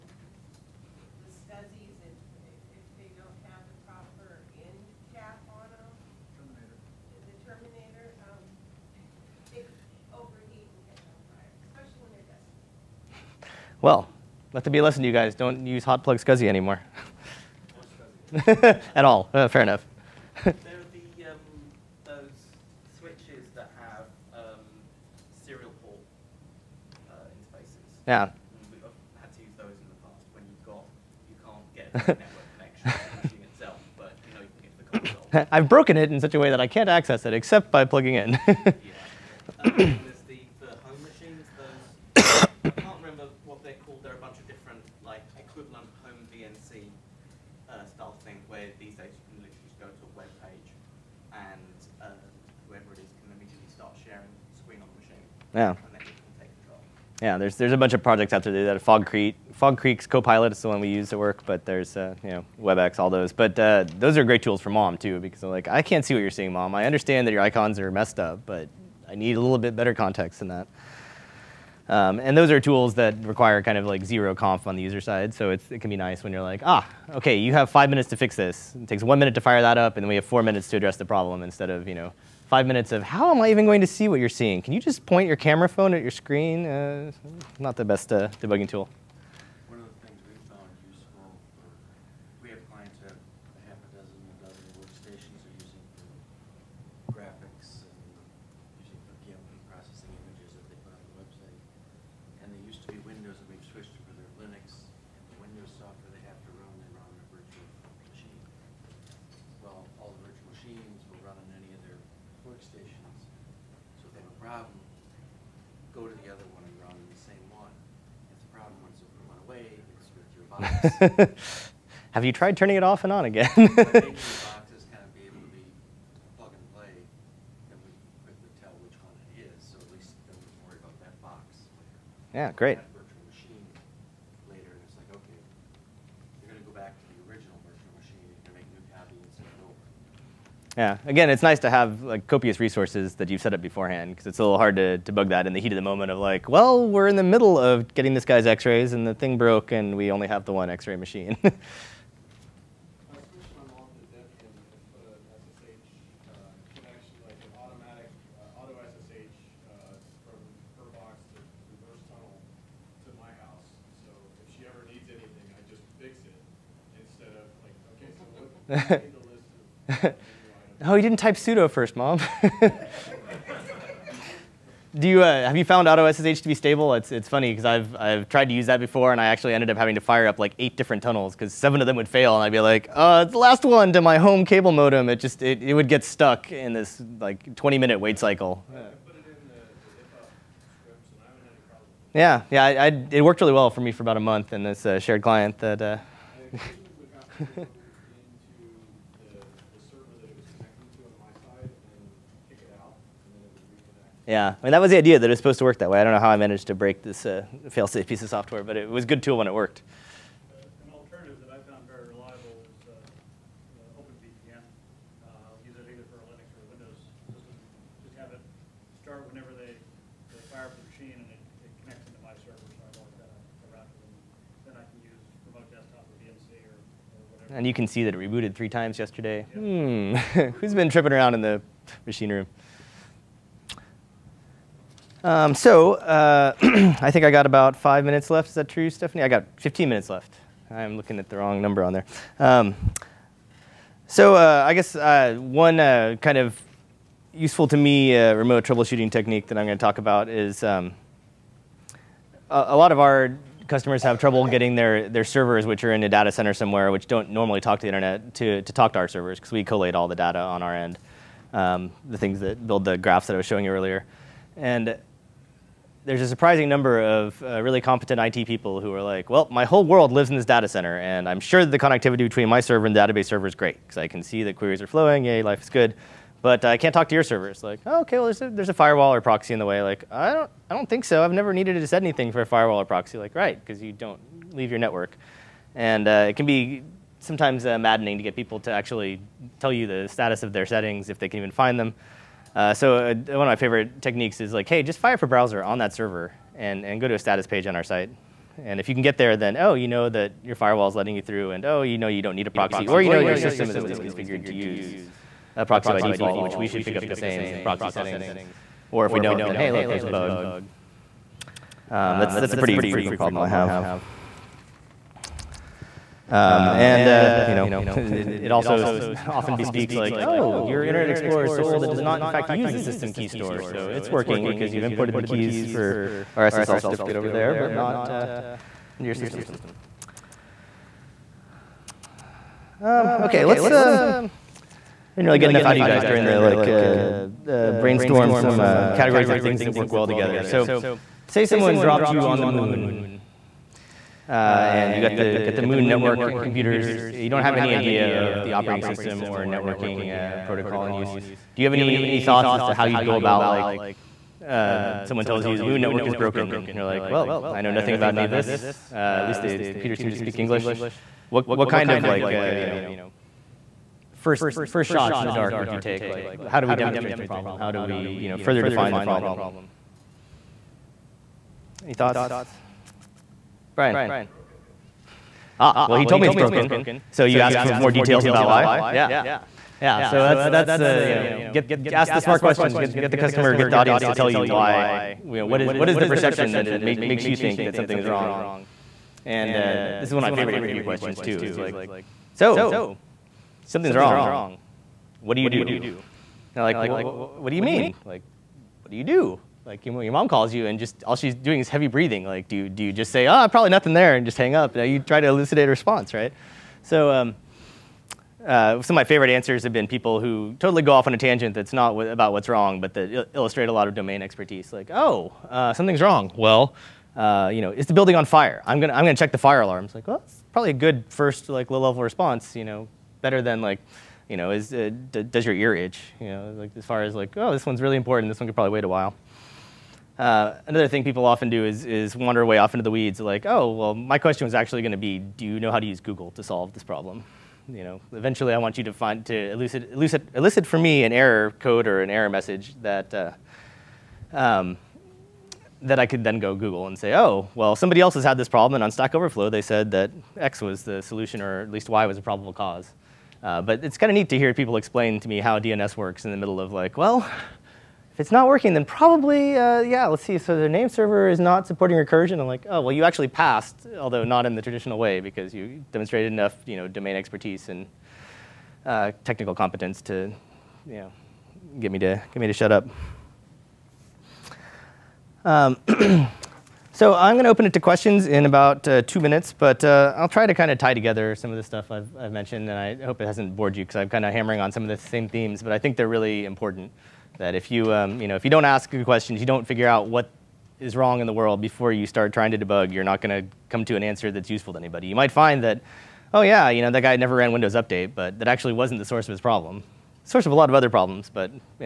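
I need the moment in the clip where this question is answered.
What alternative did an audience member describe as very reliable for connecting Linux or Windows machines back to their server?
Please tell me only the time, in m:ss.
3:34.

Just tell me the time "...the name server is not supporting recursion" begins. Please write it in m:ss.
7:40.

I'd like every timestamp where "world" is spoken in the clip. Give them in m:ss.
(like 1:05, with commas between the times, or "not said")
4:29, 8:11.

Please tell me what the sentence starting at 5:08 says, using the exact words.
Or if we don't, then hey, look, there's a bug.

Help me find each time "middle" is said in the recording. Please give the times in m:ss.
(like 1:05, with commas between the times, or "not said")
7:36.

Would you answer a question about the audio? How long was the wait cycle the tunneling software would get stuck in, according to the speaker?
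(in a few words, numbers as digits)
20 minutes.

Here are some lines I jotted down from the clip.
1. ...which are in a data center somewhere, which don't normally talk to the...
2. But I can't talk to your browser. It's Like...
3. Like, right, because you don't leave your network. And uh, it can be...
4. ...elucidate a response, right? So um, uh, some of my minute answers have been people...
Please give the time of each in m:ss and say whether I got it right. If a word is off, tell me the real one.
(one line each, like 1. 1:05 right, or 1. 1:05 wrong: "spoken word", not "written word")
1. 4:15 right
2. 4:36 wrong: "server", not "browser"
3. 4:43 right
4. 6:45 wrong: "favorite", not "minute".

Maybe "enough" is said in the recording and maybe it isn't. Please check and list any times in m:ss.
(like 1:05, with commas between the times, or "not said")
0:19, 5:35, 7:46.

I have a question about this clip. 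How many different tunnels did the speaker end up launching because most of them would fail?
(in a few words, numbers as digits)
8.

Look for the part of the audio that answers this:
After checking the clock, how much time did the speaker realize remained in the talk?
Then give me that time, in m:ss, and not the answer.
3:59.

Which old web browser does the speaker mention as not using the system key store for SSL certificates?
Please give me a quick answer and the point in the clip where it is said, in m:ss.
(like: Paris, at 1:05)
Internet Explorer, at 5:20.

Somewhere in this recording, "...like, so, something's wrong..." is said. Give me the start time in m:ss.
6:31.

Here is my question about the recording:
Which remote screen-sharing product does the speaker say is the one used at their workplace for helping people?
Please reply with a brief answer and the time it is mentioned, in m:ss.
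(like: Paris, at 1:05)
Fog Creek Copilot, at 0:59.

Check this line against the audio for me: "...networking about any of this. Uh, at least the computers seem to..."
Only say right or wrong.
wrong.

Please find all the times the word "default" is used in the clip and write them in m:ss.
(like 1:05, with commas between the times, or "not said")
5:06.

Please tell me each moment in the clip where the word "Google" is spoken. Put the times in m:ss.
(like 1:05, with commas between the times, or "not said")
7:15, 7:26.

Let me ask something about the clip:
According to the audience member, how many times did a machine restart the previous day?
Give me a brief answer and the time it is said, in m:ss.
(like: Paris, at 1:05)
3, at 3:48.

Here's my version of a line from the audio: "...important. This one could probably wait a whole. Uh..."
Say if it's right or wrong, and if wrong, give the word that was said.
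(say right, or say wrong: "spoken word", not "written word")
wrong: "while", not "whole".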